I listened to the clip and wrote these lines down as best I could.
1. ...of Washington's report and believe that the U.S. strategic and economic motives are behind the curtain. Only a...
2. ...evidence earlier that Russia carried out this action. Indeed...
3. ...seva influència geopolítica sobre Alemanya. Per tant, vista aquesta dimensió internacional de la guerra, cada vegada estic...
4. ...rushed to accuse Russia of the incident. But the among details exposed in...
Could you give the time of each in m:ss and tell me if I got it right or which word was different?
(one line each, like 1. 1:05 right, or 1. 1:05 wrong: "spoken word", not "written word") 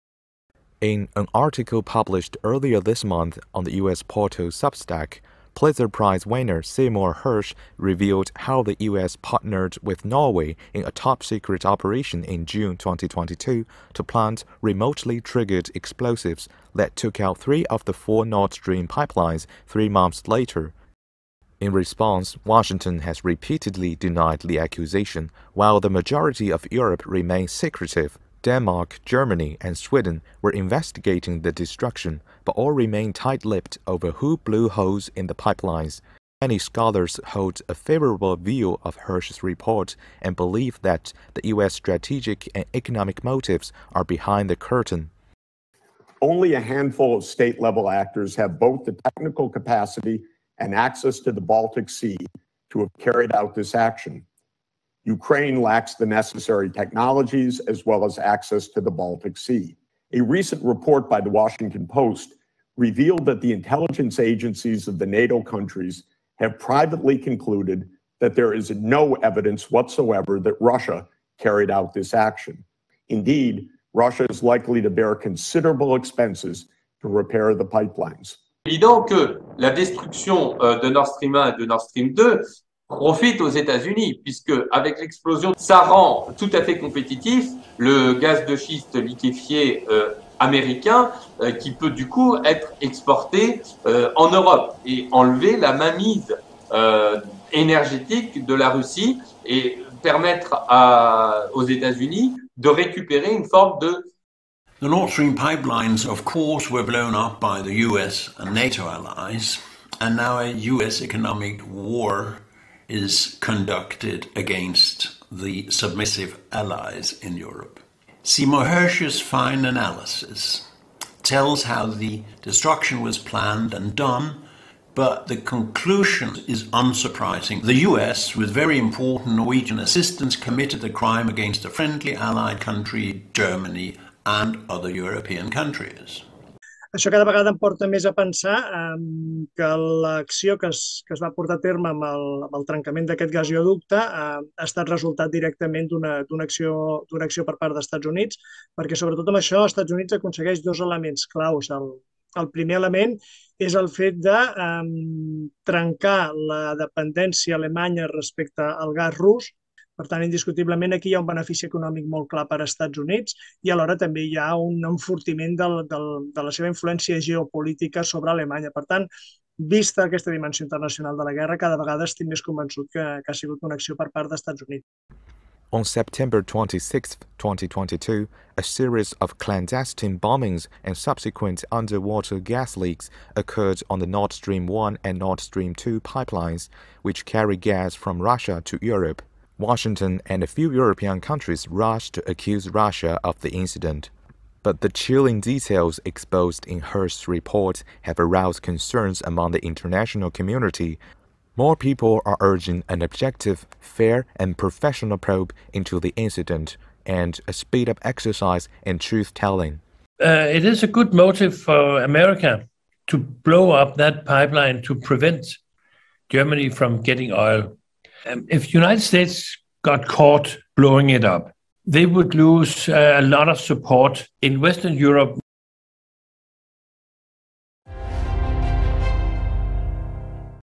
1. 0:38 wrong: "Hersh", not "Washington"
2. 1:09 wrong: "whatsoever", not "earlier"
3. 2:46 right
4. 3:11 wrong: "chilling", not "among".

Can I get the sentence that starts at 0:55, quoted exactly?
Ukraine lacks the necessary technologies as well as access to the Baltic Sea.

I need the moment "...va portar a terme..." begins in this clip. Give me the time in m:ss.
2:21.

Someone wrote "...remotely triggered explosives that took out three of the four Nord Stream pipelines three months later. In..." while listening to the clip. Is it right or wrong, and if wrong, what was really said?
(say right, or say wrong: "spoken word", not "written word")
right.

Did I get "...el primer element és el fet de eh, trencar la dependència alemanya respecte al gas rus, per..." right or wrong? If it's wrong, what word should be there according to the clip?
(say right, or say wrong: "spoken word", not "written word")
right.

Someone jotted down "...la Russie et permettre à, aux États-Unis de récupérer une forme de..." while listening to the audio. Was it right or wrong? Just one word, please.
right.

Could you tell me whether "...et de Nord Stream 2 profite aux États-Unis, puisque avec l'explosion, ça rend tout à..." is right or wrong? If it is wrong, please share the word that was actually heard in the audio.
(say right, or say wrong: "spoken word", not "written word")
right.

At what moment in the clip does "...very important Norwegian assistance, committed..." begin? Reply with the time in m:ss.
2:08.